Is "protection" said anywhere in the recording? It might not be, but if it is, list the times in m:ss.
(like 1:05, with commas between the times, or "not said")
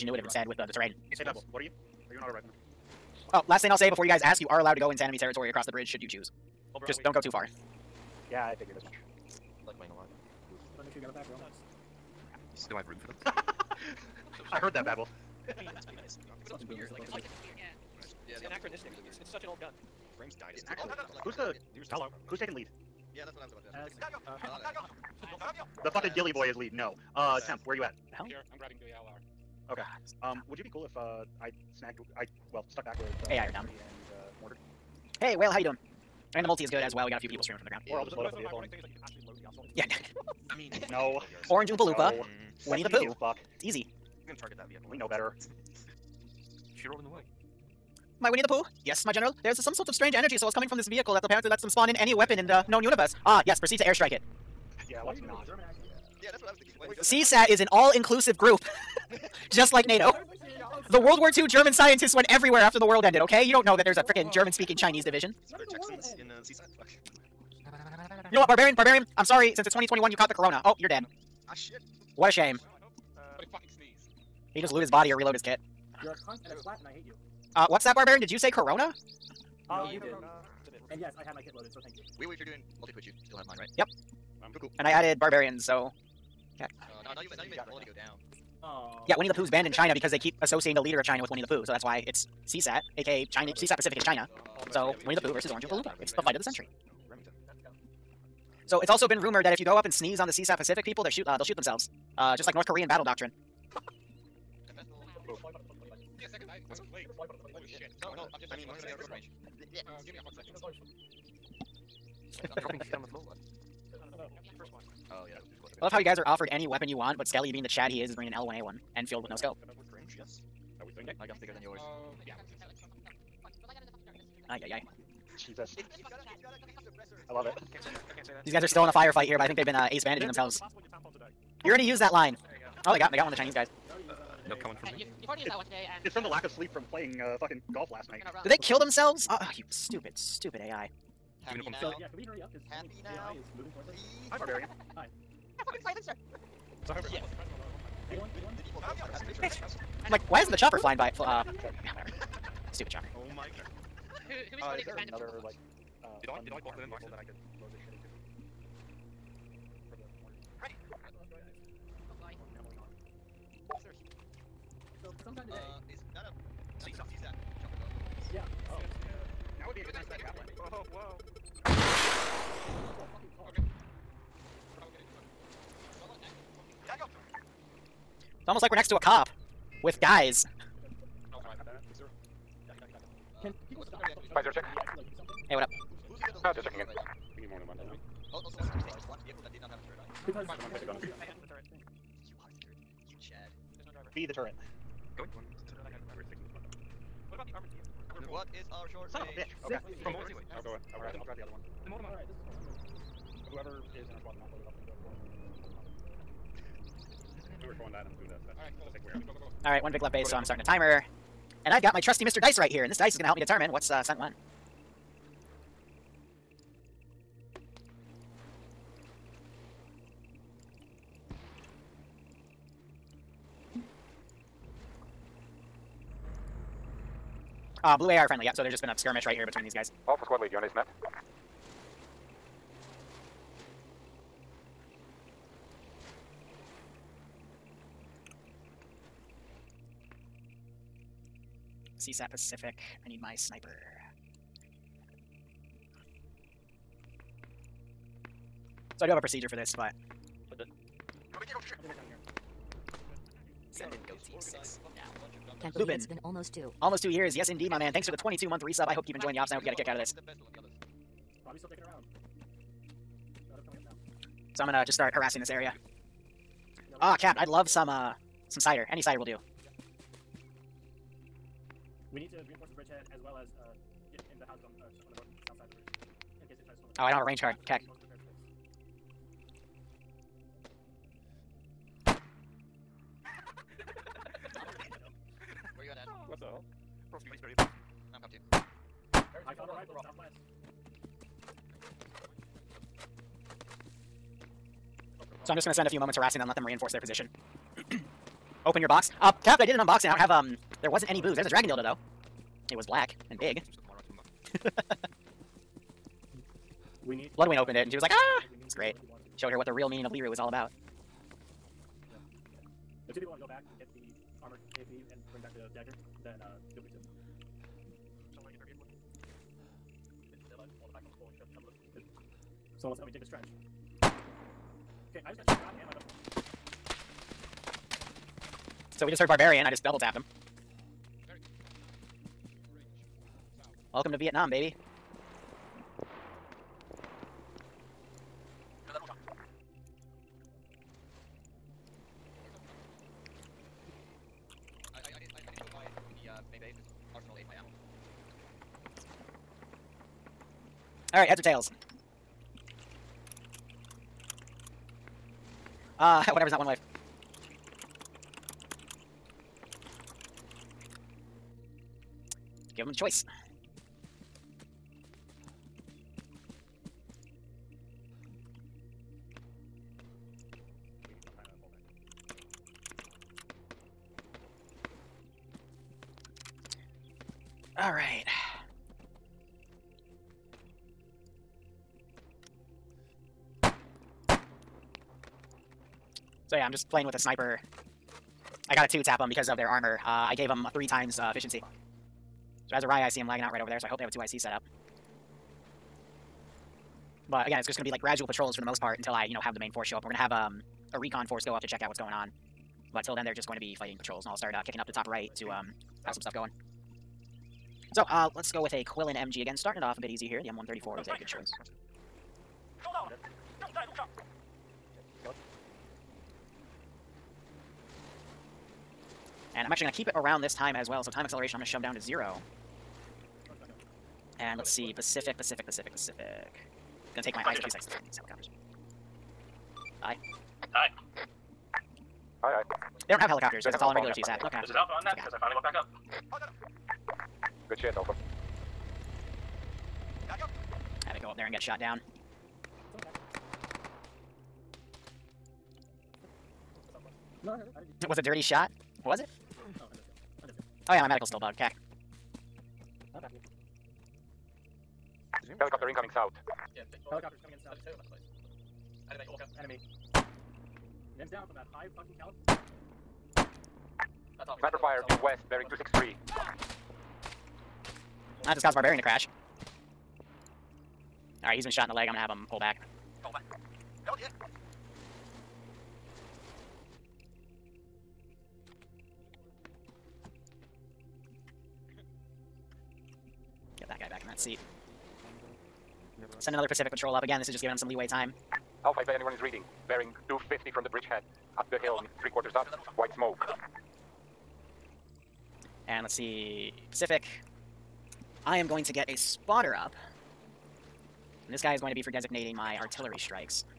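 not said.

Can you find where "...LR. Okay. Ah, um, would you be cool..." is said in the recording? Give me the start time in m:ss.
0:29.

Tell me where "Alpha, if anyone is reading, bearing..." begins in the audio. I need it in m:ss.
8:08.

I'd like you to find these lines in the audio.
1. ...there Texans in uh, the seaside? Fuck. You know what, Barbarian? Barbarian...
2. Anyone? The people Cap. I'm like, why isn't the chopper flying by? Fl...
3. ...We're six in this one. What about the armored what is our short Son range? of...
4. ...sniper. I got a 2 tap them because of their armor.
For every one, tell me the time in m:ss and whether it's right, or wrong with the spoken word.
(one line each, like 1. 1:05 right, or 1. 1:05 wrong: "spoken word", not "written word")
1. 1:05 right
2. 2:28 wrong: "Bitch", not "Cap"
3. 3:16 right
4. 6:27 right.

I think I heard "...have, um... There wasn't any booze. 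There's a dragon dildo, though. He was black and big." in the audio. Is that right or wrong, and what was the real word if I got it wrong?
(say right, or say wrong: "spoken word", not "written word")
right.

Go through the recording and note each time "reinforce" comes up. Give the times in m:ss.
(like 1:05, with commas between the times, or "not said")
4:32, 4:56.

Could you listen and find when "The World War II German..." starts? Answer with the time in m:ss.
1:00.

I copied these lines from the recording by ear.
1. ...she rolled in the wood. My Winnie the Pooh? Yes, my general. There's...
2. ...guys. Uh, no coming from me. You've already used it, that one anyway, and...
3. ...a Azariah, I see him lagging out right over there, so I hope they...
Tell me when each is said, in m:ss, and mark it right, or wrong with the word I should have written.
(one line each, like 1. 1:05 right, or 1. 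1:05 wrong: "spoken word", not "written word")
1. 0:46 right
2. 2:13 wrong: "today", not "anyway"
3. 6:32 right.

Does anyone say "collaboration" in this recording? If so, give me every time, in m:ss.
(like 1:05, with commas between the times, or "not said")
not said.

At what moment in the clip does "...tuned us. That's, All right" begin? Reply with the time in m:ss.
3:28.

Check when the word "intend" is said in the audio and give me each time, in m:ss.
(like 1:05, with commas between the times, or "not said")
not said.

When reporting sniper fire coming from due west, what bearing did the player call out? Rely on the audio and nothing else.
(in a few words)
263.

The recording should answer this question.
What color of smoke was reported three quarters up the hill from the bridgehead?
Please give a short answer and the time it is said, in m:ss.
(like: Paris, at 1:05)
white, at 8:12.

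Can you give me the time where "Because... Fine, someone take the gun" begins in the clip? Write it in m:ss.
3:10.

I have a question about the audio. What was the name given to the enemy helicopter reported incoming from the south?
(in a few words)
Orca.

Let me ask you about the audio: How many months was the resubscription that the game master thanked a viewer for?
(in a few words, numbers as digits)
22.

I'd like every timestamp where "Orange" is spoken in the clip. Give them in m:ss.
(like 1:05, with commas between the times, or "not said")
0:41, 1:35.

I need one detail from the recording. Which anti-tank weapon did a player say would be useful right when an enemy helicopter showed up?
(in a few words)
javelin.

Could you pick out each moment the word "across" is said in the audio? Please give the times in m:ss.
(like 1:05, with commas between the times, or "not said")
0:05, 4:36, 4:47.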